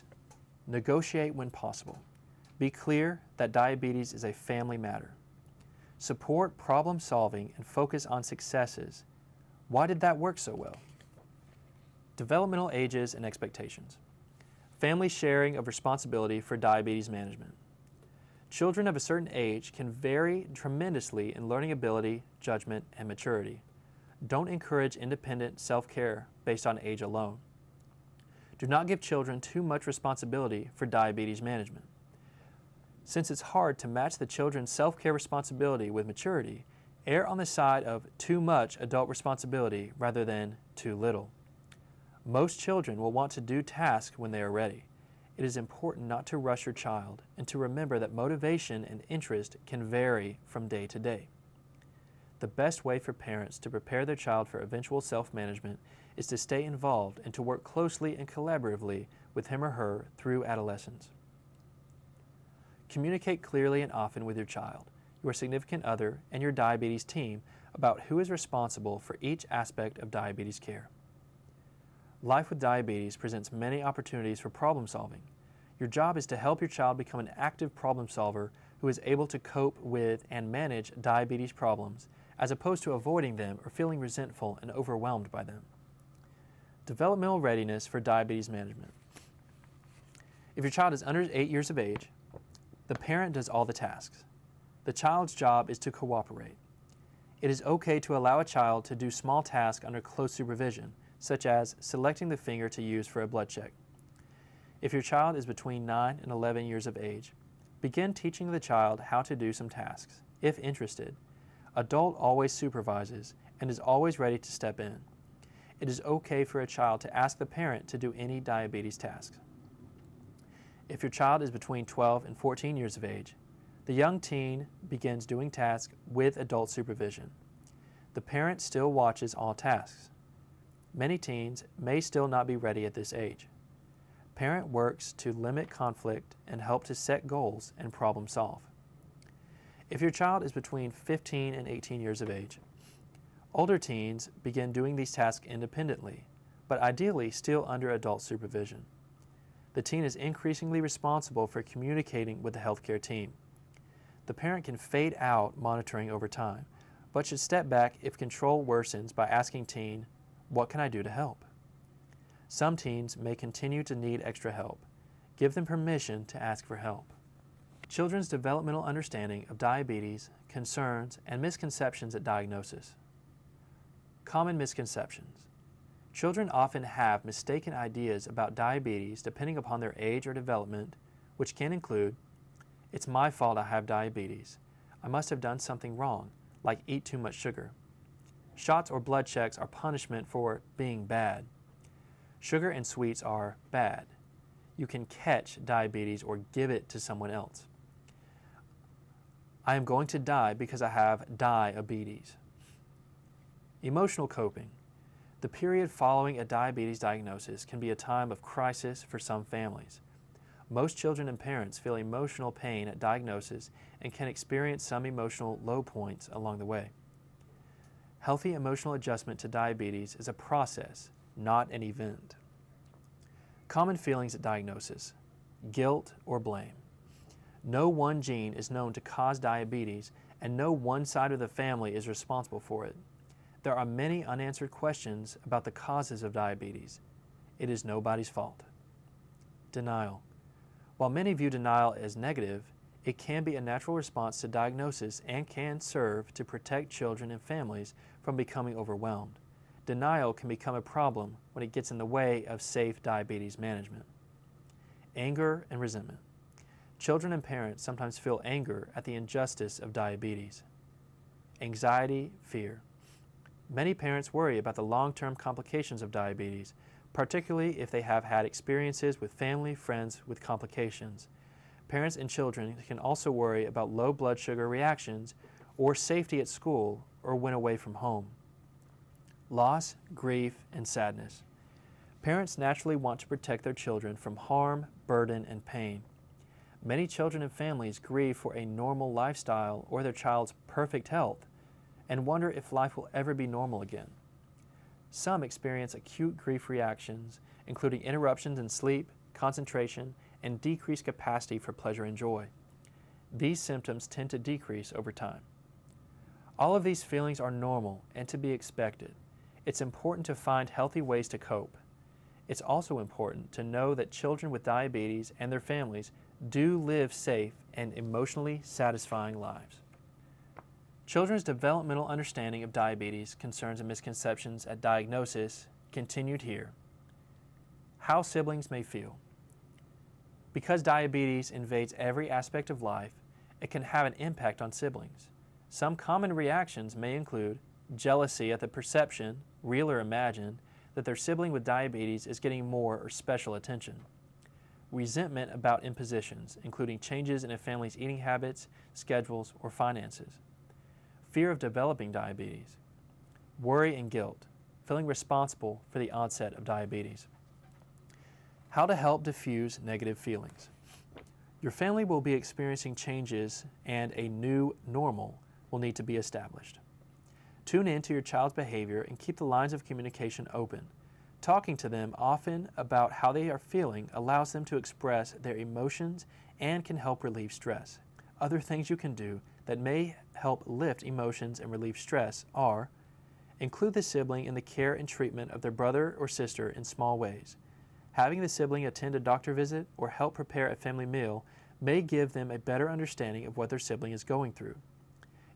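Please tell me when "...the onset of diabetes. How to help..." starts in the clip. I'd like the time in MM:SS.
05:55.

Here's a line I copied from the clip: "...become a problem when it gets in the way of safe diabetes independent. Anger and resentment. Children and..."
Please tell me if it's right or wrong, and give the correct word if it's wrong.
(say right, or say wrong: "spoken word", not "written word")
wrong: "management", not "independent".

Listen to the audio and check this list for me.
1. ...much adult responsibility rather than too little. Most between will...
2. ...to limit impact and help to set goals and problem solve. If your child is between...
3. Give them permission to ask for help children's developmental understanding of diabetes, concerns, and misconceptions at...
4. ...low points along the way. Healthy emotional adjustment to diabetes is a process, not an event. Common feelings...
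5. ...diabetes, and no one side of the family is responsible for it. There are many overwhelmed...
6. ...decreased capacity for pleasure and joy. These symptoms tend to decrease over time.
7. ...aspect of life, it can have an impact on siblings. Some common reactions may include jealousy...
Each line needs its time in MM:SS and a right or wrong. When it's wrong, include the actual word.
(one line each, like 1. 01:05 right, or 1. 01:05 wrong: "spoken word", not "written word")
1. 00:38 wrong: "children", not "between"
2. 02:15 wrong: "conflict", not "impact"
3. 02:45 right
4. 03:35 right
5. 03:49 wrong: "unanswered", not "overwhelmed"
6. 05:00 right
7. 05:32 right.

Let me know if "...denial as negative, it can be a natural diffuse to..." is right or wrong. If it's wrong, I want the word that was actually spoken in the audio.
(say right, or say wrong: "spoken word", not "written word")
wrong: "response", not "diffuse".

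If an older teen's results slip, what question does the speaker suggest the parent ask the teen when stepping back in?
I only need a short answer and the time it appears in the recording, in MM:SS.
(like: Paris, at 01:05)
What can I do to help?, at 02:40.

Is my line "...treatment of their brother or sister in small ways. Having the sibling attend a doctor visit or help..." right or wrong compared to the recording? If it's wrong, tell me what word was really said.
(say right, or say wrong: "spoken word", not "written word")
right.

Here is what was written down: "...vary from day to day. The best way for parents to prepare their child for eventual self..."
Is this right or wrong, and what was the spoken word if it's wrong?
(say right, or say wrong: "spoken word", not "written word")
right.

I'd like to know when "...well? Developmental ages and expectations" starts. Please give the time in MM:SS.
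00:10.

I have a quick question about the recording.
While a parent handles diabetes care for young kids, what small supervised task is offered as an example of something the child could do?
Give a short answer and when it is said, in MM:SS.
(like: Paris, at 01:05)
Selecting the finger, at 01:41.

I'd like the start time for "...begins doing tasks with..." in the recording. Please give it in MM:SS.
02:04.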